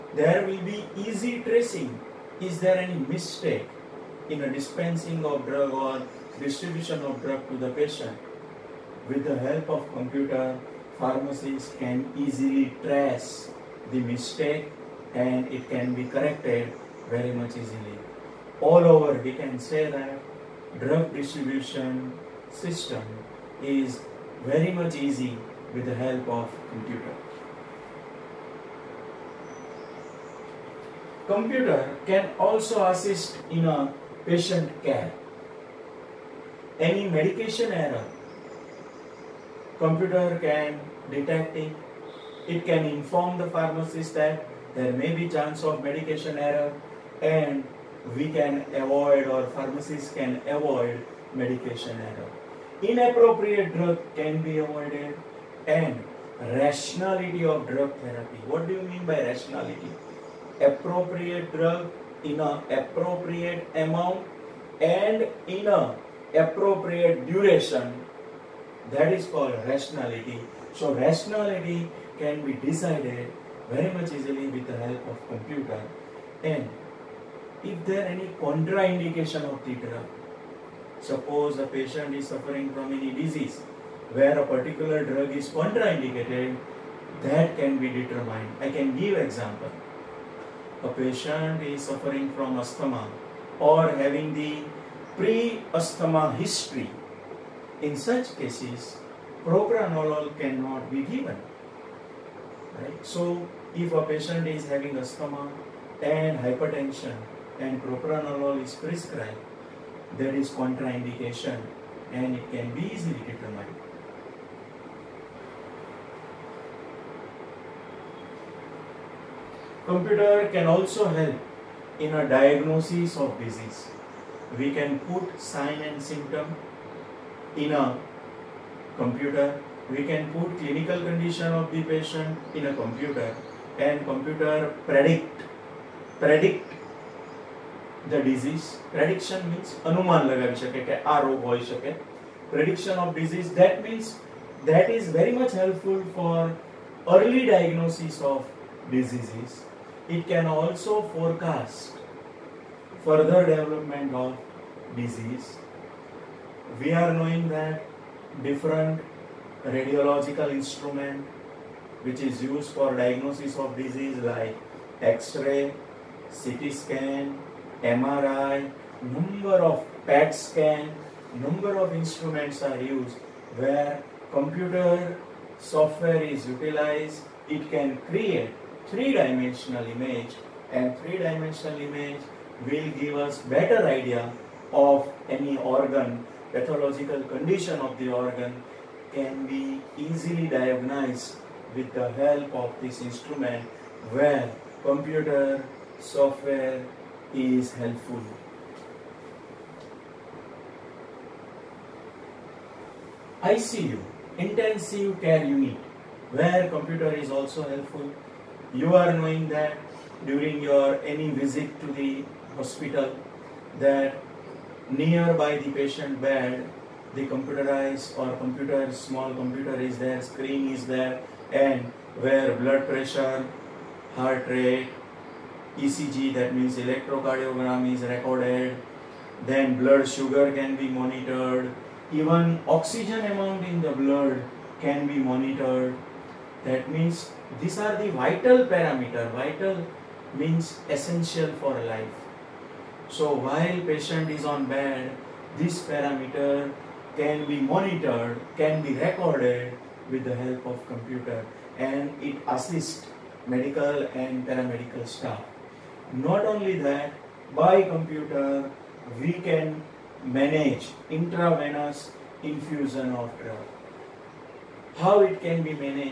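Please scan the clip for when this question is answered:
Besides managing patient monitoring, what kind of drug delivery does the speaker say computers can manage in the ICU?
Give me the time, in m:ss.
4:21.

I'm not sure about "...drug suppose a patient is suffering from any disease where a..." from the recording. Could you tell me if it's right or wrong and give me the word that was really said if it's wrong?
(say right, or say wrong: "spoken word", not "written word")
right.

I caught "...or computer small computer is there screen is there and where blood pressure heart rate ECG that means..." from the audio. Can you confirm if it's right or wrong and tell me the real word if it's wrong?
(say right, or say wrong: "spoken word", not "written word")
right.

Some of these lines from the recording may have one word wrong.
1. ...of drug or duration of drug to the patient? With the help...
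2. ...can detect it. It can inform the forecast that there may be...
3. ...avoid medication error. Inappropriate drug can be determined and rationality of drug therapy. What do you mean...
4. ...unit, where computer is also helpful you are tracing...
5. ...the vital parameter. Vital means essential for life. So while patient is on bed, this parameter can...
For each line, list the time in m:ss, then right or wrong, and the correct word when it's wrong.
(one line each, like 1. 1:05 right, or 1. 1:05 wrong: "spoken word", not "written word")
1. 0:05 wrong: "distribution", not "duration"
2. 0:40 wrong: "pharmacist", not "forecast"
3. 0:50 wrong: "avoided", not "determined"
4. 3:25 wrong: "knowing", not "tracing"
5. 3:57 right.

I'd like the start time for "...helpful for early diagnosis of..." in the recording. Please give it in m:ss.
2:25.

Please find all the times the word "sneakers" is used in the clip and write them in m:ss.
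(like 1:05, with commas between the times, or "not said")
not said.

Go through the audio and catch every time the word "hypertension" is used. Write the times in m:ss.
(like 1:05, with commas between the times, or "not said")
1:46.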